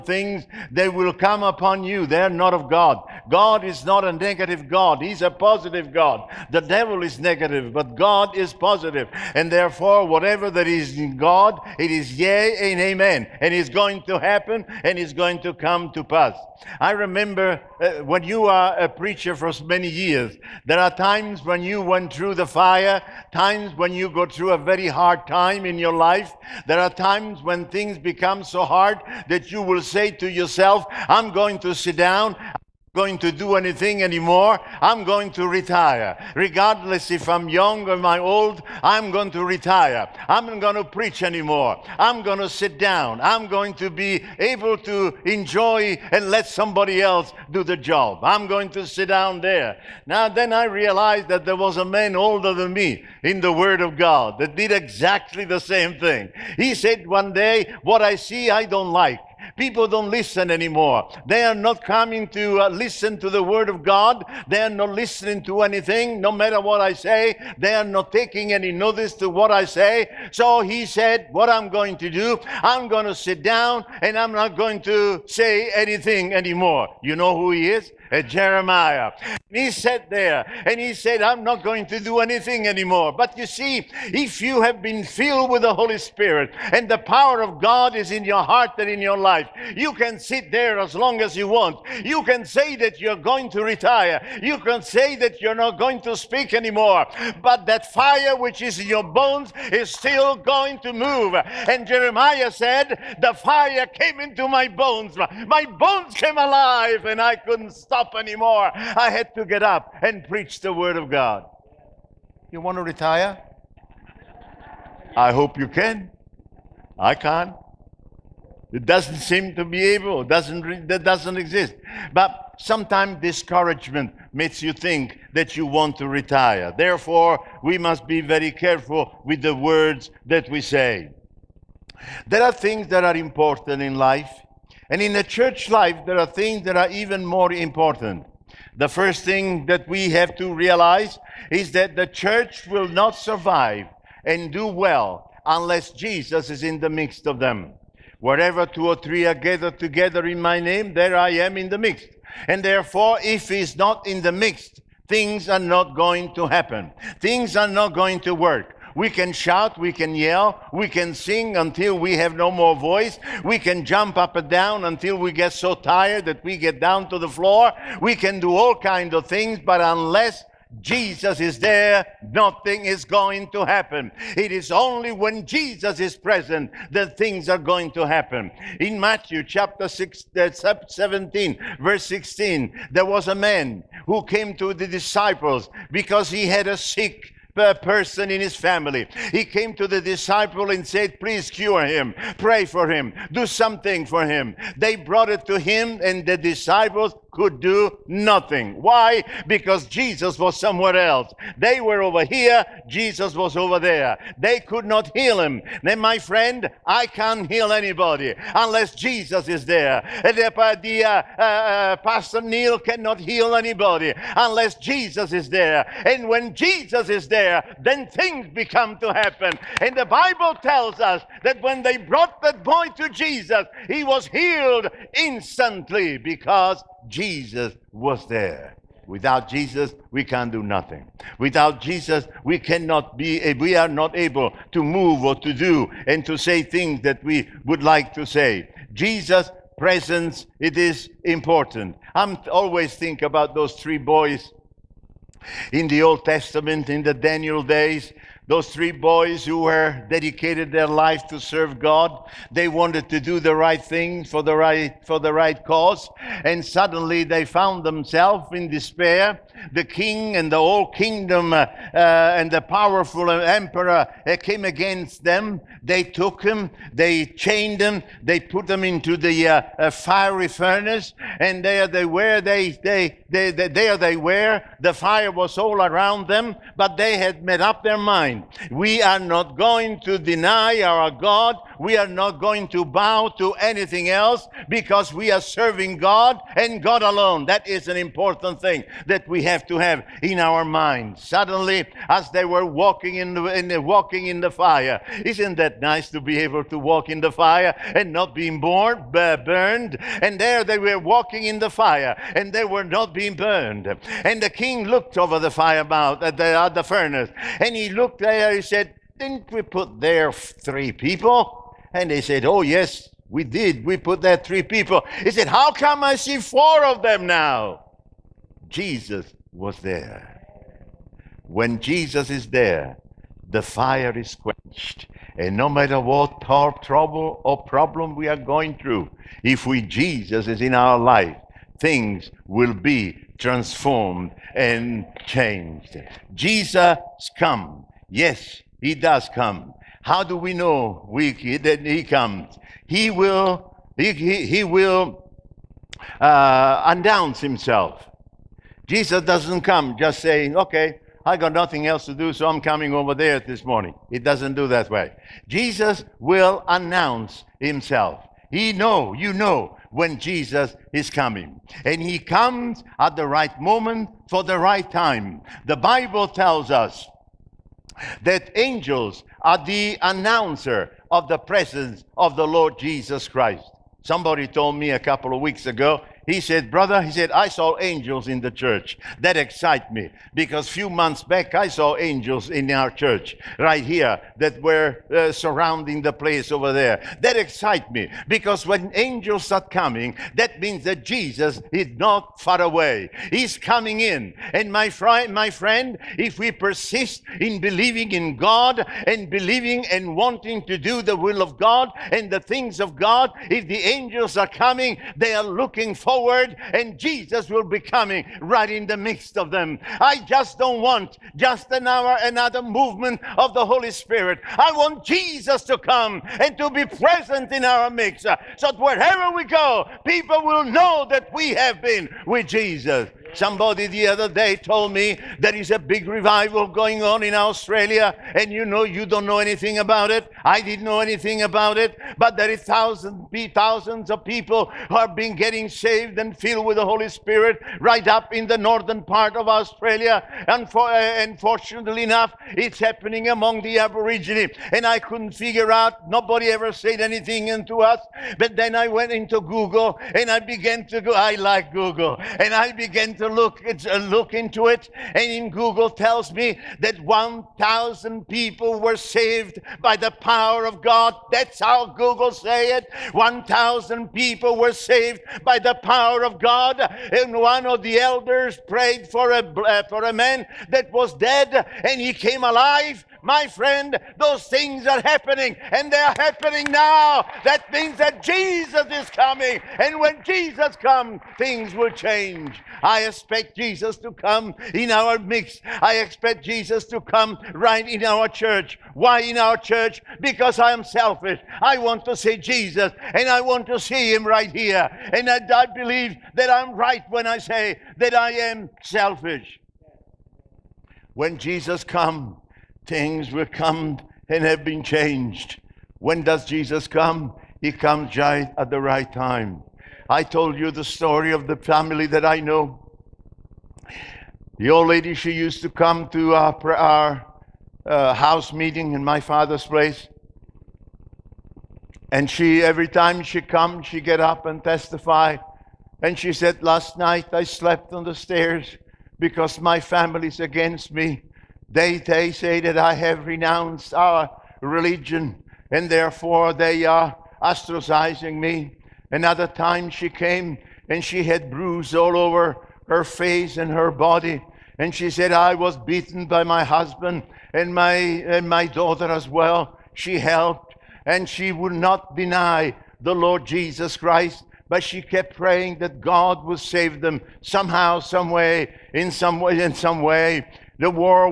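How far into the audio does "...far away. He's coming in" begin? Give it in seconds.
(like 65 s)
392 s.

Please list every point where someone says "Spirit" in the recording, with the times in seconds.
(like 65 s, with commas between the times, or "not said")
85 s, 413 s, 437 s.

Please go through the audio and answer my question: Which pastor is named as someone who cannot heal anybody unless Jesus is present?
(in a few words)
Pastor Neil.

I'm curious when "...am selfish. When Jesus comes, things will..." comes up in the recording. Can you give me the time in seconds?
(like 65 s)
498 s.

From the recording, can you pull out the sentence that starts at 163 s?
We can jump up and down until we get so tired that we get down to the floor.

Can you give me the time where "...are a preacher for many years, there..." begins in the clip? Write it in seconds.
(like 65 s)
18 s.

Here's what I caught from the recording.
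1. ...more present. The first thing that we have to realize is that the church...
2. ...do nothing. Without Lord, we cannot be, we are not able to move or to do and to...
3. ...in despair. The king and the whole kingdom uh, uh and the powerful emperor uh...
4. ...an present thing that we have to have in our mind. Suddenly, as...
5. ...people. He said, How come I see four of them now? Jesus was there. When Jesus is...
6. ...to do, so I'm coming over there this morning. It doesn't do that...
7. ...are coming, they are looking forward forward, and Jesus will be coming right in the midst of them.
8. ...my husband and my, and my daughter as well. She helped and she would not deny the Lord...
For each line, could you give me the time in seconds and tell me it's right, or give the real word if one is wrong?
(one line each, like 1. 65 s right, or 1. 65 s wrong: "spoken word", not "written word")
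1. 137 s wrong: "important", not "present"
2. 230 s wrong: "Jesus", not "Lord"
3. 258 s right
4. 287 s wrong: "important", not "present"
5. 314 s right
6. 352 s right
7. 404 s right
8. 546 s right.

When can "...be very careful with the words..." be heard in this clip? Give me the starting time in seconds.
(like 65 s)
128 s.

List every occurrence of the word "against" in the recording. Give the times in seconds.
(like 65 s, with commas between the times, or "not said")
264 s, 530 s.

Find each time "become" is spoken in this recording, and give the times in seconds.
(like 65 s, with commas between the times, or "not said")
27 s, 218 s.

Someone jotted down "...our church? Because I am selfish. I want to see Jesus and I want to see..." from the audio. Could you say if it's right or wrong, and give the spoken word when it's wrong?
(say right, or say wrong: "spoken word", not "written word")
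right.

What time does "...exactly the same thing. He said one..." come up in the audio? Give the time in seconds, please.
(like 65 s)
54 s.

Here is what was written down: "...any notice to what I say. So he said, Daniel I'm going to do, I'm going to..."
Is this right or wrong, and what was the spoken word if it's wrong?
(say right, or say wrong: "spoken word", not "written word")
wrong: "What", not "Daniel".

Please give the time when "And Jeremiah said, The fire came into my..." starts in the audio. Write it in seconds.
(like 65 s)
101 s.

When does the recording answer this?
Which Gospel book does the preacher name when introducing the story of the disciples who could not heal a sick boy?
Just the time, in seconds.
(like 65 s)
178 s.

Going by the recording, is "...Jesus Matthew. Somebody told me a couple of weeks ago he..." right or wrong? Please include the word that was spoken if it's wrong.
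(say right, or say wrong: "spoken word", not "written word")
wrong: "Christ", not "Matthew".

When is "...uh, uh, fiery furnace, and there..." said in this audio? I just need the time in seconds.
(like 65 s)
269 s.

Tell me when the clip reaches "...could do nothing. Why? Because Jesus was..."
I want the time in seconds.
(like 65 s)
197 s.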